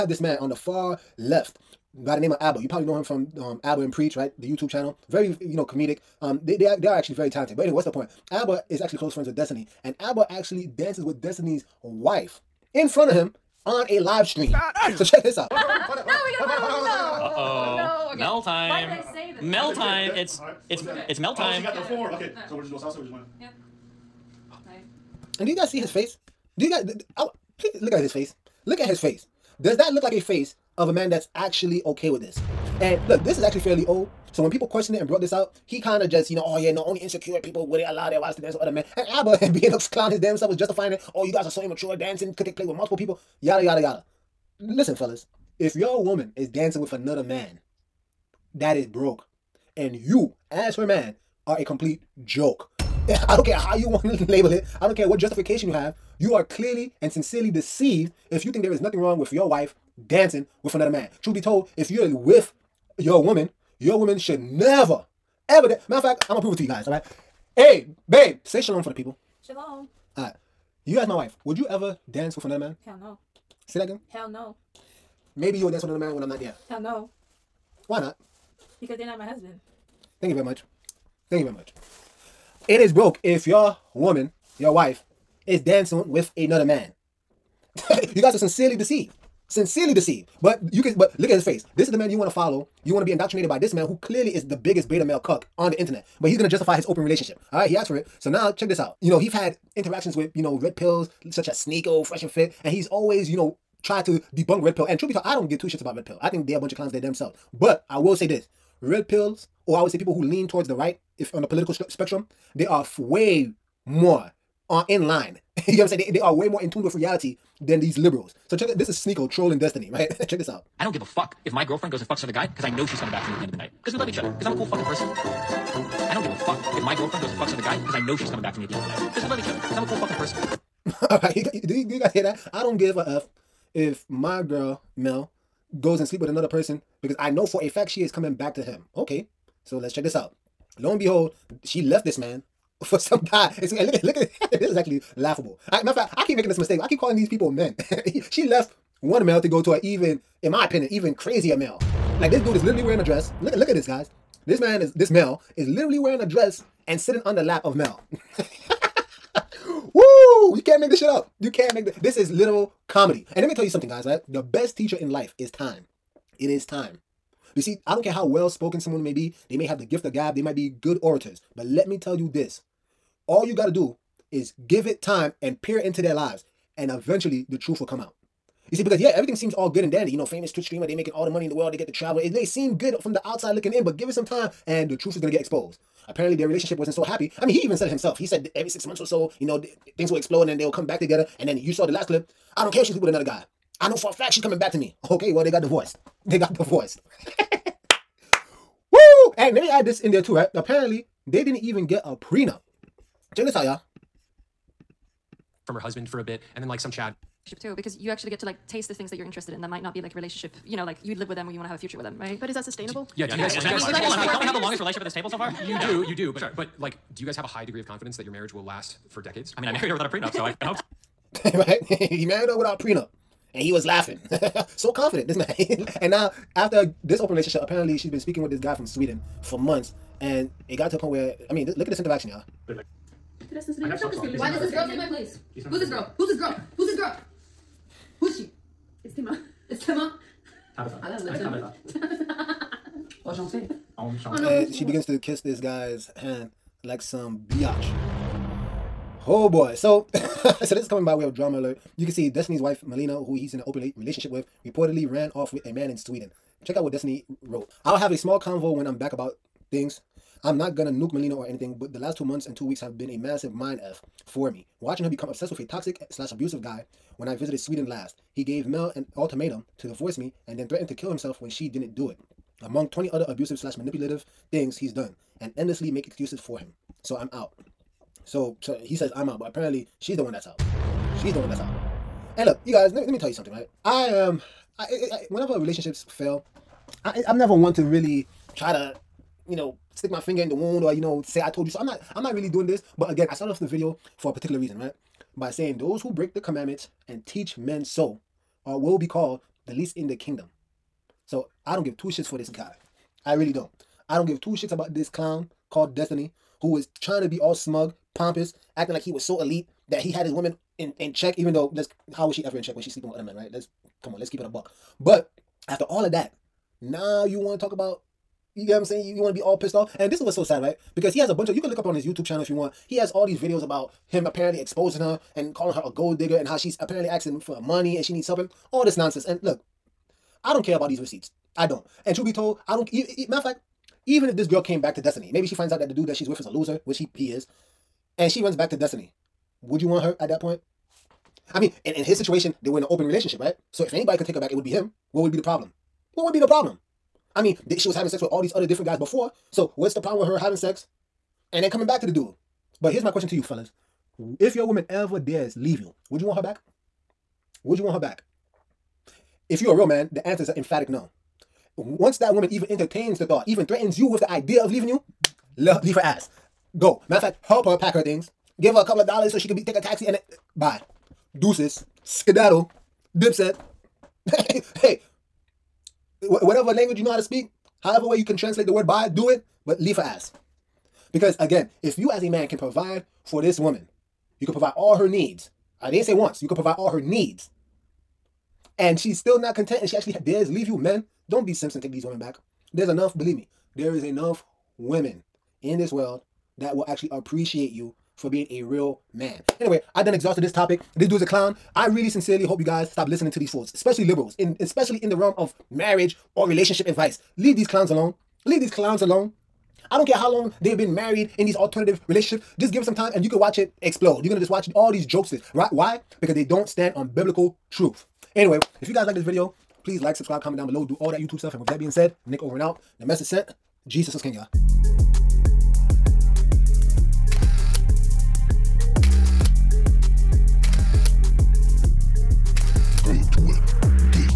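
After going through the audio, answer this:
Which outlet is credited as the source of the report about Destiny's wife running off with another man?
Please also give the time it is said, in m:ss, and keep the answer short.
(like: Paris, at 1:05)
Drama Alert, at 4:11.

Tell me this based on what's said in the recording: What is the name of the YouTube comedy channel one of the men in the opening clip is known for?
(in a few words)
Abba and Preach.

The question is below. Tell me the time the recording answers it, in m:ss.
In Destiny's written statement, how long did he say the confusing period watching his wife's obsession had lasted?
4:22.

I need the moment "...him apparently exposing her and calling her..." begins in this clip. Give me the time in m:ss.
5:24.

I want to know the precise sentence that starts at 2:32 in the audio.
Like this dude is literally wearing a dress.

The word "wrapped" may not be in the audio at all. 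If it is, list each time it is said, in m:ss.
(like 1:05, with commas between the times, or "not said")
not said.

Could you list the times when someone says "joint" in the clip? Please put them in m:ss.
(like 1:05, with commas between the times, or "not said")
not said.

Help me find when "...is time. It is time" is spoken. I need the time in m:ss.
2:45.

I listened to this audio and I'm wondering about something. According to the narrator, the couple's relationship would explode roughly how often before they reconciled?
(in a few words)
every 6 months.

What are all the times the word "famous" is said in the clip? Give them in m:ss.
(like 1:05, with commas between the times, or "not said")
3:00.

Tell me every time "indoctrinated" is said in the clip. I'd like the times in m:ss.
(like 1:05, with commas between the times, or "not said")
1:33.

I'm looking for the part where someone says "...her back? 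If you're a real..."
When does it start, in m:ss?
5:57.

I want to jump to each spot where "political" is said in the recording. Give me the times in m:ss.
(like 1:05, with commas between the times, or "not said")
1:51.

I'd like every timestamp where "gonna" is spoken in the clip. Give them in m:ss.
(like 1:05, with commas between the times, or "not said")
0:15, 1:06, 1:36, 4:20, 6:54.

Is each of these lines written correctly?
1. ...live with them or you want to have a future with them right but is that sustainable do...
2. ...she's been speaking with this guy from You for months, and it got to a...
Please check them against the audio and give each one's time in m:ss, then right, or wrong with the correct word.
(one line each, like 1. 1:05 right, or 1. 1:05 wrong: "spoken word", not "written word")
1. 3:31 right
2. 3:47 wrong: "Sweden", not "You".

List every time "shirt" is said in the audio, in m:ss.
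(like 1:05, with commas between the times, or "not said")
not said.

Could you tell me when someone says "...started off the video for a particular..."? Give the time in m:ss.
4:53.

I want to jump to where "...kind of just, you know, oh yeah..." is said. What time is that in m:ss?
0:35.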